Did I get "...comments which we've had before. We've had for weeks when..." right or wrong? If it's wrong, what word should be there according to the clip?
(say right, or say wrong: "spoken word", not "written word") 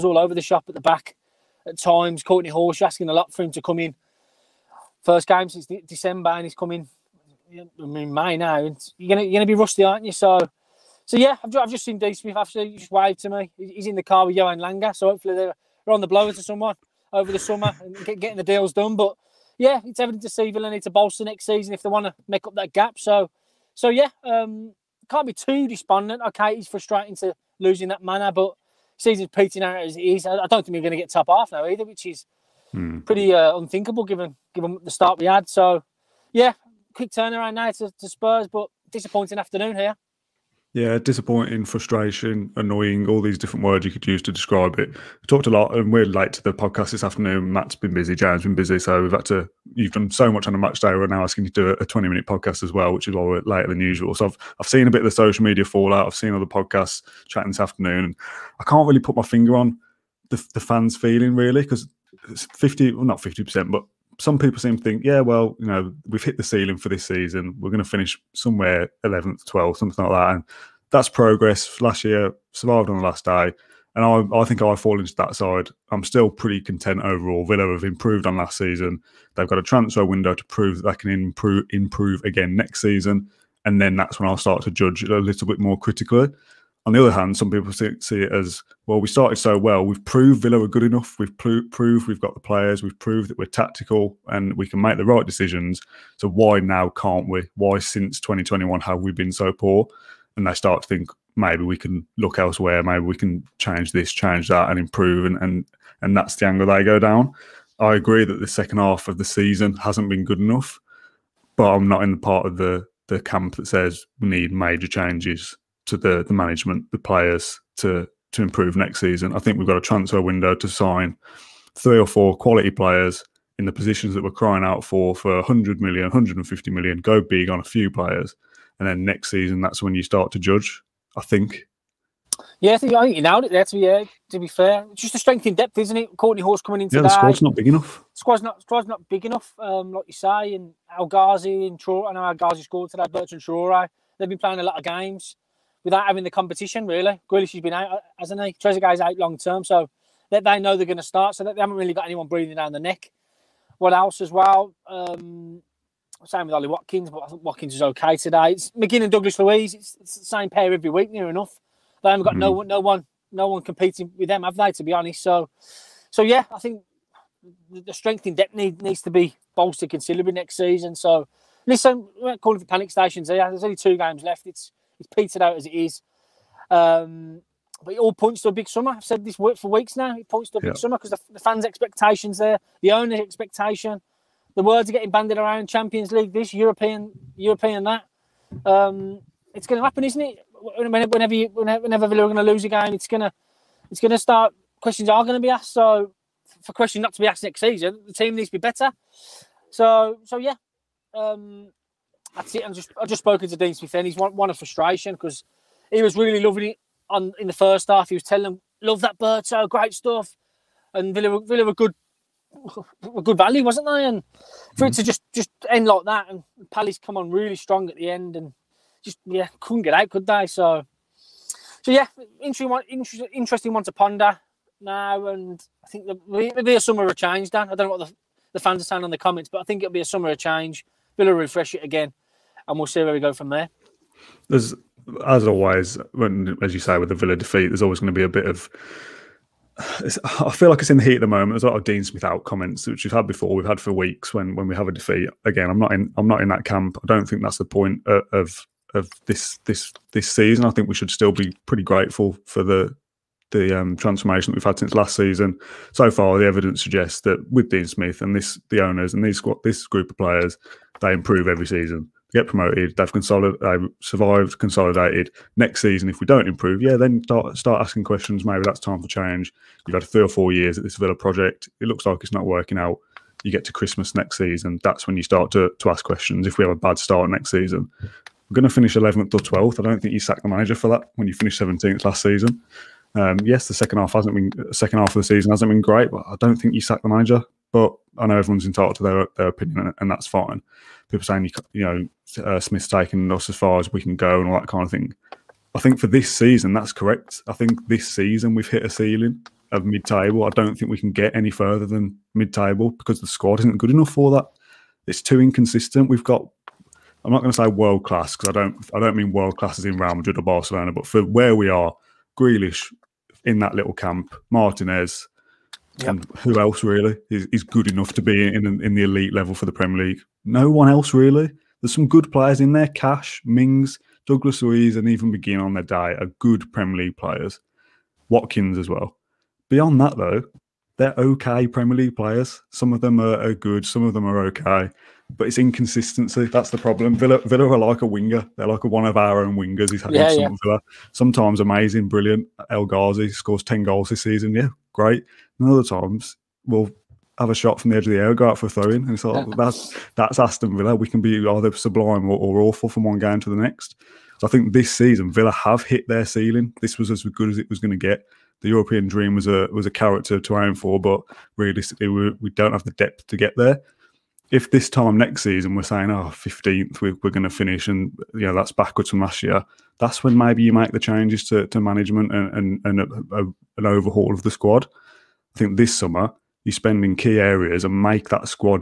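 right.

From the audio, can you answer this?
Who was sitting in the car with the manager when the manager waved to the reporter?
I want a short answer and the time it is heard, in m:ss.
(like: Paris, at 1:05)
Johan Lange, at 0:14.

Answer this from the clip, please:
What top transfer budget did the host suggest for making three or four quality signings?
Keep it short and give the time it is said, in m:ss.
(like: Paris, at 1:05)
150 million, at 2:06.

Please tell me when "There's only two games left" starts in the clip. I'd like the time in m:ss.
2:53.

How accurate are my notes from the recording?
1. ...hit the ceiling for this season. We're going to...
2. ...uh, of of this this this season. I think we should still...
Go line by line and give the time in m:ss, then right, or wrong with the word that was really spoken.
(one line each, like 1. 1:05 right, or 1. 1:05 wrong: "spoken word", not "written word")
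1. 1:06 right
2. 4:08 right.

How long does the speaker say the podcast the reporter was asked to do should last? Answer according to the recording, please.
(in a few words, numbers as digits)
20 minutes.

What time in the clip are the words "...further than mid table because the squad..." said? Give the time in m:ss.
5:01.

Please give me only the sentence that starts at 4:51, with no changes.
People saying you know uh, Smith's taken us as far as we can go and all that kind of thing.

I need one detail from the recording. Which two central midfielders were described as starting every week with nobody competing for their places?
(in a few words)
McGinn and Douglas Luiz.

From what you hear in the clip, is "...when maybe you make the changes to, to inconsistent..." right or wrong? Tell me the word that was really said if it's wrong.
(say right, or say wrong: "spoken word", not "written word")
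wrong: "management", not "inconsistent".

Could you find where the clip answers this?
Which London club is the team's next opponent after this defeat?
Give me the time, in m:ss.
0:38.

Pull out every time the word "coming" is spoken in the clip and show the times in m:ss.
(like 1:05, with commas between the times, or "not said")
0:06, 2:16.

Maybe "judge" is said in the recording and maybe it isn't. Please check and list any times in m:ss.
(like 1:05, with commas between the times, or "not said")
1:24, 2:10.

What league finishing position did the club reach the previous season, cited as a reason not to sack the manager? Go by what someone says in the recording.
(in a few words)
17th.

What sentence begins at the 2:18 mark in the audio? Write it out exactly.
Squad's not squad's not big enough.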